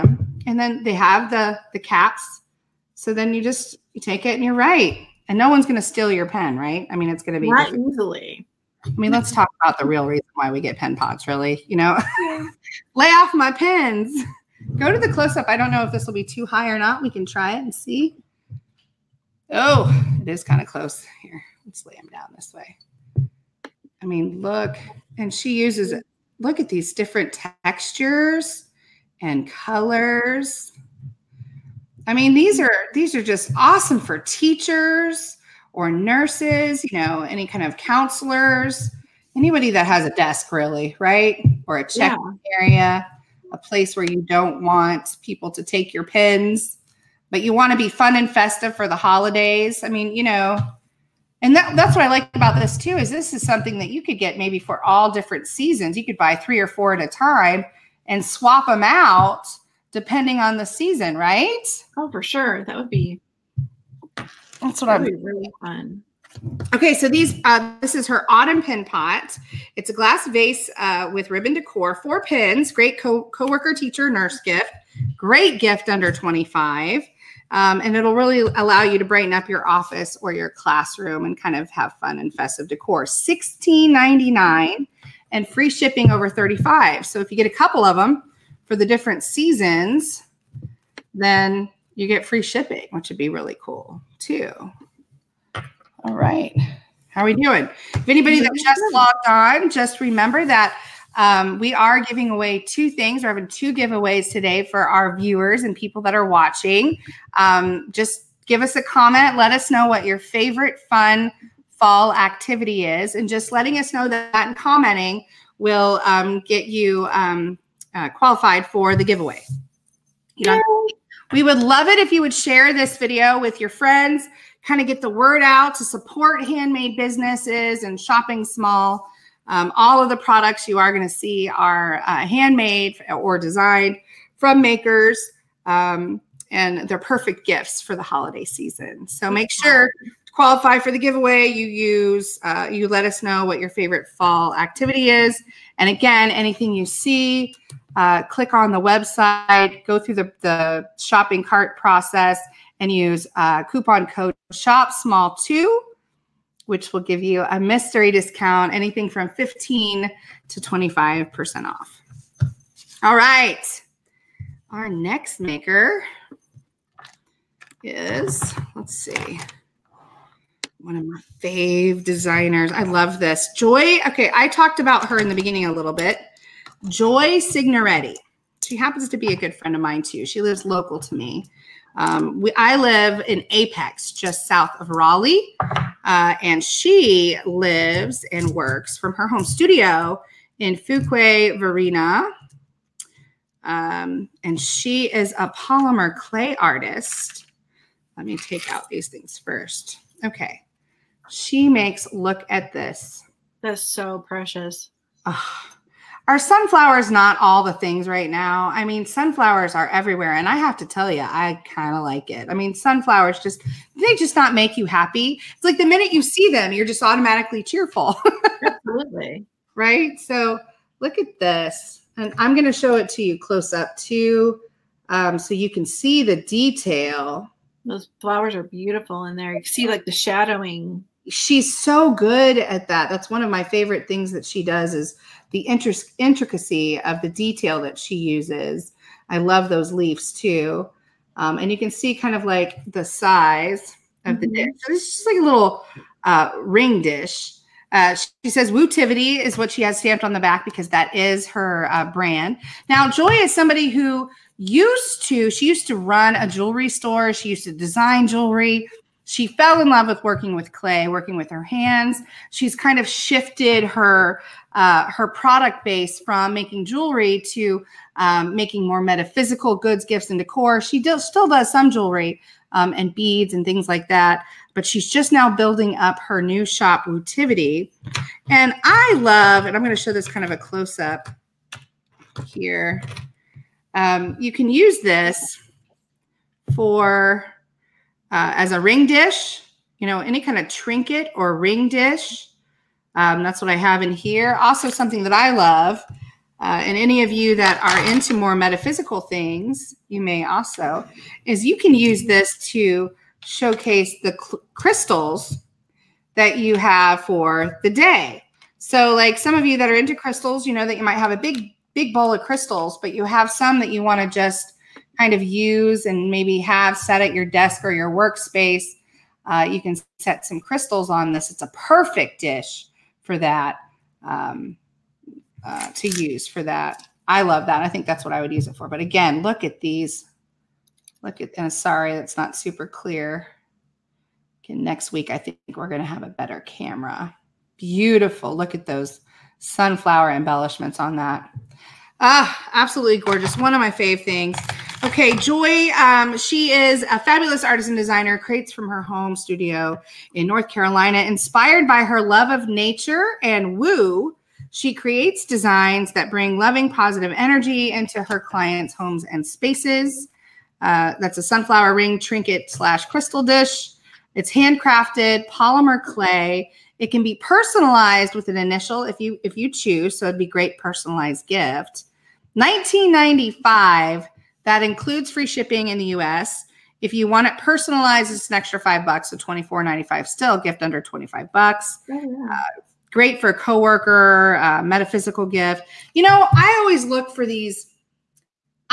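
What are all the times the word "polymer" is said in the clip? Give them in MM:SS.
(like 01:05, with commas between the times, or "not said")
03:15, 06:05.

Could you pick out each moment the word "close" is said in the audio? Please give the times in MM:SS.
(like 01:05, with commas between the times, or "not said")
00:15, 00:20, 03:43, 04:40.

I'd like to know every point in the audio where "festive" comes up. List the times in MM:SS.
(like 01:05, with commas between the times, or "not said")
00:48, 01:22.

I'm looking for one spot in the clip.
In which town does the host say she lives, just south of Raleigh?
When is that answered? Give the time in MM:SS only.
03:03.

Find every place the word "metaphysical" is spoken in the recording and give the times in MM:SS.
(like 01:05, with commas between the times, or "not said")
04:29, 04:58, 06:24.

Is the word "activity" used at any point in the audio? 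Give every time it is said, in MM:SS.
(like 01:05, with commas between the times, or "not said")
01:52, 02:24.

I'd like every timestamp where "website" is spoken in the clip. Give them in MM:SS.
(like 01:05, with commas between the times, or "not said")
02:28.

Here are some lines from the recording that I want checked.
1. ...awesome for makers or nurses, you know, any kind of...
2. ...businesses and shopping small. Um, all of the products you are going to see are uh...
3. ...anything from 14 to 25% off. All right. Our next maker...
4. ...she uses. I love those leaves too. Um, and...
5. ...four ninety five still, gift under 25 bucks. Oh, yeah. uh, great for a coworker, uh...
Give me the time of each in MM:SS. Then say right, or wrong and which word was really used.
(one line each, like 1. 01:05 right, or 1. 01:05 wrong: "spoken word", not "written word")
1. 00:33 wrong: "teachers", not "makers"
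2. 02:06 right
3. 02:38 wrong: "15", not "14"
4. 03:57 right
5. 06:19 right.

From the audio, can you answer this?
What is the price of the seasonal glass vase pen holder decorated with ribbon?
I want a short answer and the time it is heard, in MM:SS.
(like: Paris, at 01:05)
$16.99, at 01:23.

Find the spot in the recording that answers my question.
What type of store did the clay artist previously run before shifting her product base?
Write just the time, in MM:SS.
04:16.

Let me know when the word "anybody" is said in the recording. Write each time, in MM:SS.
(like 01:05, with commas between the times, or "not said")
00:39, 01:38.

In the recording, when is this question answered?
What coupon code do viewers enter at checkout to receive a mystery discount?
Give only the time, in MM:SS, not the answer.
02:34.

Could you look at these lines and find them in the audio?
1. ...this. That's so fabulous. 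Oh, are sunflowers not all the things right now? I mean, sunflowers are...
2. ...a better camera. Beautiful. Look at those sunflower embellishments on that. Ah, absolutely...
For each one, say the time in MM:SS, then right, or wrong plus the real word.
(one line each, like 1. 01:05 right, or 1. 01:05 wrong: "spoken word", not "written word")
1. 03:22 wrong: "precious", not "fabulous"
2. 05:36 right.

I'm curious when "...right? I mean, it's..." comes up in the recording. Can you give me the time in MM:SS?
00:06.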